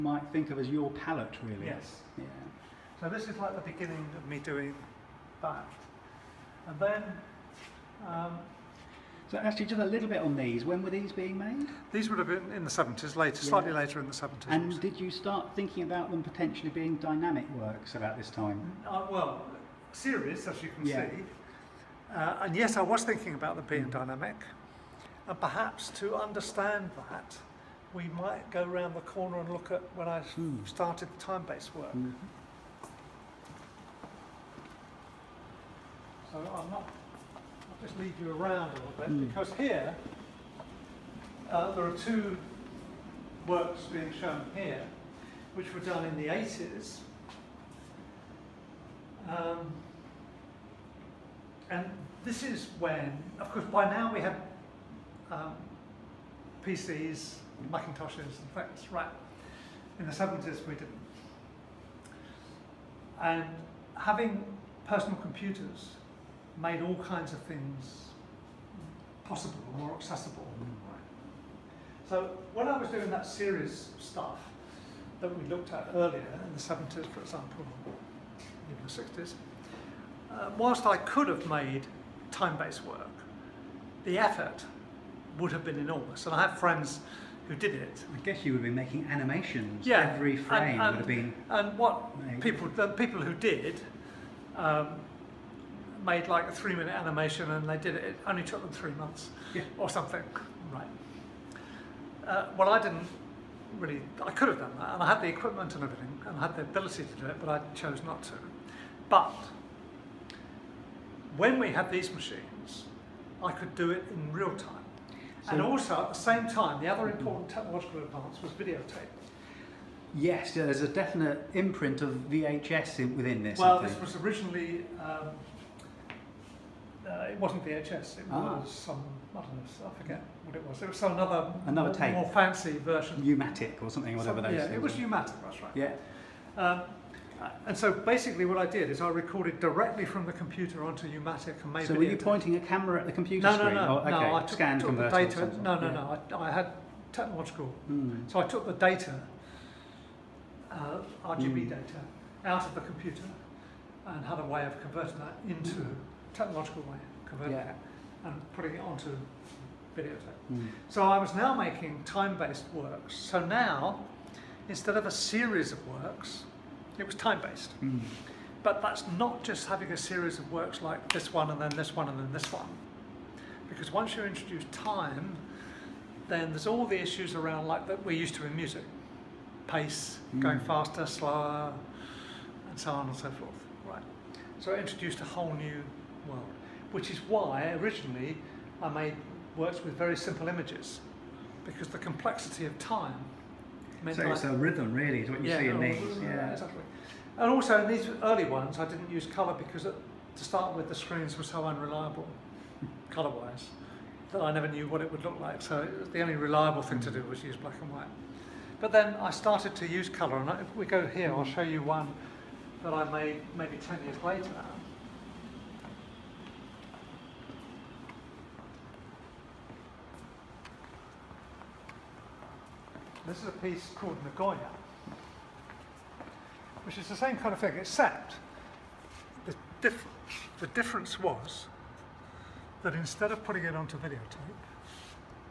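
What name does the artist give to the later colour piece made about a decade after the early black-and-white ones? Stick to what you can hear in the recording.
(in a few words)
Nagoya.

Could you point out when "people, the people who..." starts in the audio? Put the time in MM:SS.
01:32.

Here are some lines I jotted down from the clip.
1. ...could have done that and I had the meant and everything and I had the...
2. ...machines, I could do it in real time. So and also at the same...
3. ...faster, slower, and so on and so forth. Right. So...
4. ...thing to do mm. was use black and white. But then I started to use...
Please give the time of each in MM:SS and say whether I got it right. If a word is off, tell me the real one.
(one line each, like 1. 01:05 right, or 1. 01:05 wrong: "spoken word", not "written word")
1. 01:44 wrong: "equipment", not "meant"
2. 01:52 right
3. 03:00 right
4. 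03:26 right.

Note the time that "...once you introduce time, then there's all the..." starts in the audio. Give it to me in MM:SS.
02:53.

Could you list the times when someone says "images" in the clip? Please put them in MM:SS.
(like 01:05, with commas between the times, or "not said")
03:10.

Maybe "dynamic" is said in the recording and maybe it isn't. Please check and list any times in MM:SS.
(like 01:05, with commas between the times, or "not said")
00:16, 00:23.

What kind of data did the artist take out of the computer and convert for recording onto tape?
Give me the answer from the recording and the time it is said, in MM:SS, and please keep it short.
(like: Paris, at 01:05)
RGB, at 02:31.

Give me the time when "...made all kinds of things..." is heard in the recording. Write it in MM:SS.
01:06.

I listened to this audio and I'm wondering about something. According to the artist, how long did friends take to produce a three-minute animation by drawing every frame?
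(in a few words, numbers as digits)
3 months.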